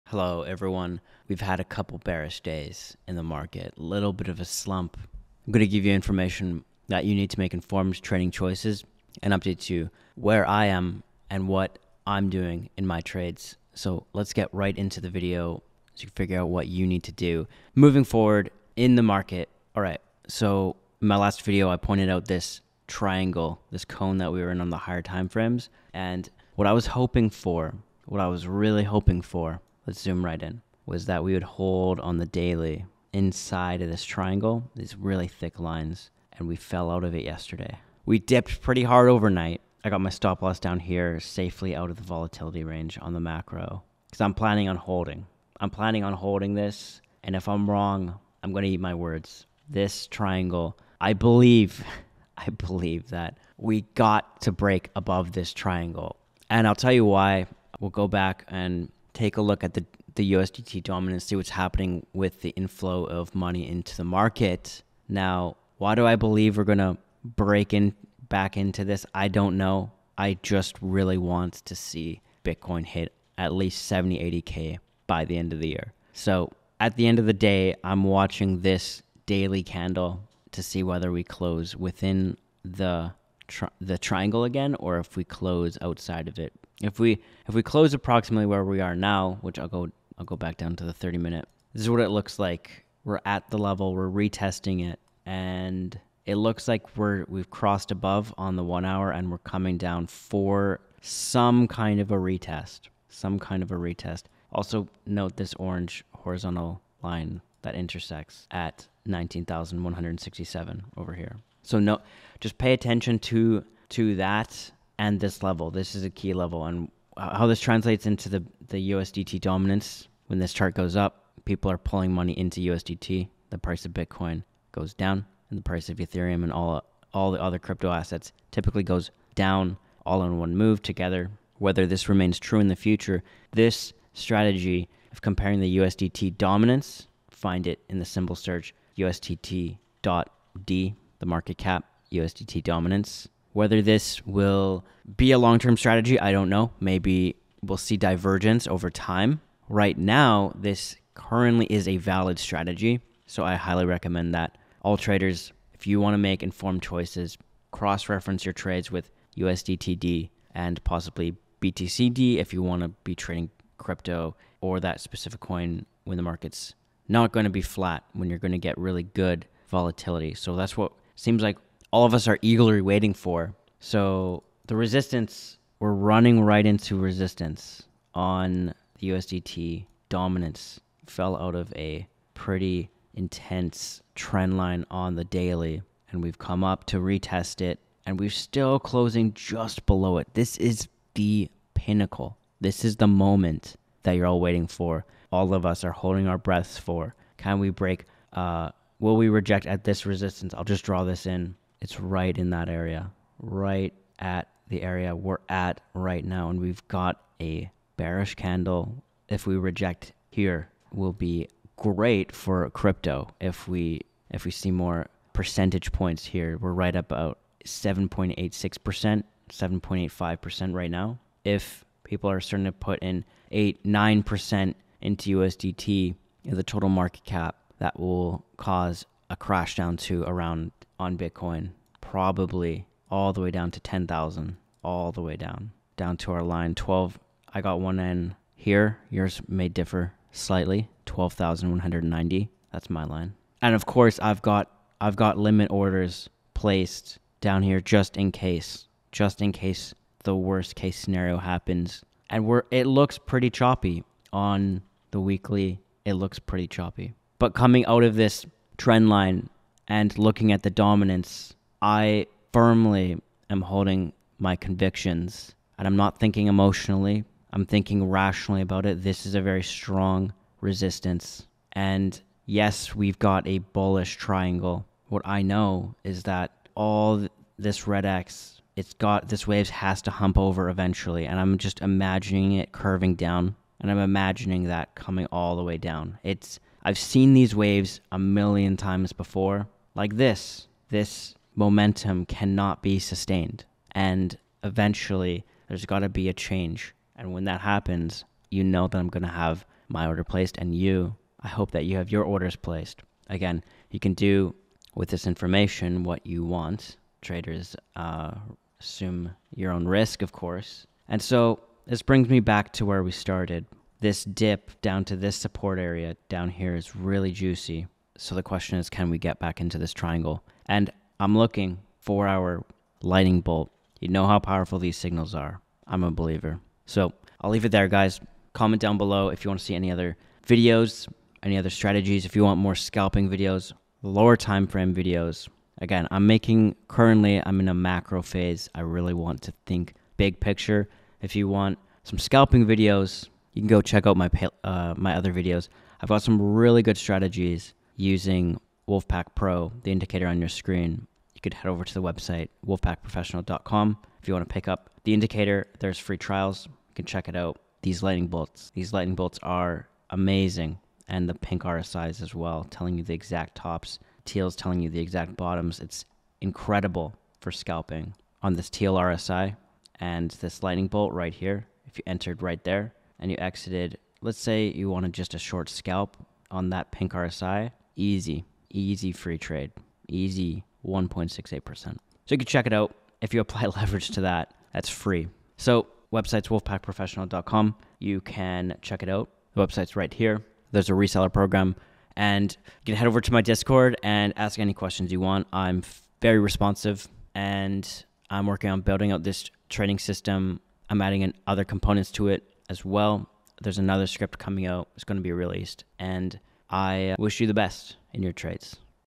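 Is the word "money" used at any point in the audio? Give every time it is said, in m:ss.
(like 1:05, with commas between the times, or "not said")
1:03, 2:02.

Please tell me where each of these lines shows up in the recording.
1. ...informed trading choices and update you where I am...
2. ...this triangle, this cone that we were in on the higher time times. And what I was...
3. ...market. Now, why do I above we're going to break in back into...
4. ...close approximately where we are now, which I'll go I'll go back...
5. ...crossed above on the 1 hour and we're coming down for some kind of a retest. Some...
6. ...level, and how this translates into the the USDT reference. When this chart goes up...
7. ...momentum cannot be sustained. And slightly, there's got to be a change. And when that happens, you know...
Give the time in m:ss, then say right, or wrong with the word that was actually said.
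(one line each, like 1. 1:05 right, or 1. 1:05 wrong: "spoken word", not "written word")
1. 0:07 right
2. 0:22 wrong: "frames", not "times"
3. 1:04 wrong: "believe", not "above"
4. 1:27 right
5. 1:37 right
6. 1:56 wrong: "dominance", not "reference"
7. 4:51 wrong: "eventually", not "slightly".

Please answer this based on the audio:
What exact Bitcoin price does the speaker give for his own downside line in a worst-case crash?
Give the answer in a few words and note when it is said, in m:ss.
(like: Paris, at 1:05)
12,190, at 4:01.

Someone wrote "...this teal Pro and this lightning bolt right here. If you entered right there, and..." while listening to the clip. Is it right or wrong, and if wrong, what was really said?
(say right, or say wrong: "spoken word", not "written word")
wrong: "RSI", not "Pro".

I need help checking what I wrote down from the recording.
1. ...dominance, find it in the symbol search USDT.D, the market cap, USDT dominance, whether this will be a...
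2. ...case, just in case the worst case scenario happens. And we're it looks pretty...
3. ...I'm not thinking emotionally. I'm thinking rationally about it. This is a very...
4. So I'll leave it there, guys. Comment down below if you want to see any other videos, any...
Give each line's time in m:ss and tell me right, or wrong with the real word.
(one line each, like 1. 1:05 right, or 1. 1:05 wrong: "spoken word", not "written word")
1. 2:16 right
2. 4:08 right
3. 4:25 right
4. 5:26 right.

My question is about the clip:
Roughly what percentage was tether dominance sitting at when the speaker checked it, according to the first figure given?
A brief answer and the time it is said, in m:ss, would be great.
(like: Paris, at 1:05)
7.86%, at 3:37.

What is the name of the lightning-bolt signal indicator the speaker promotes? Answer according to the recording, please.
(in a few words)
Wolfpack Pro.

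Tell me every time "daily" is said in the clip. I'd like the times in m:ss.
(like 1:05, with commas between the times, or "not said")
0:32, 1:19, 3:05.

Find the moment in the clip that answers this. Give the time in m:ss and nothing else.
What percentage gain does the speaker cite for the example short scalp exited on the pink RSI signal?
6:20.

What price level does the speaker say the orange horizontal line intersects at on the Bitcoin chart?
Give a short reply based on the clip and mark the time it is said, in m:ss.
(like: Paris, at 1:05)
19,167, at 1:49.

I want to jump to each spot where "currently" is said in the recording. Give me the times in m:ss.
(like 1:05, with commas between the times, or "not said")
2:31, 5:36.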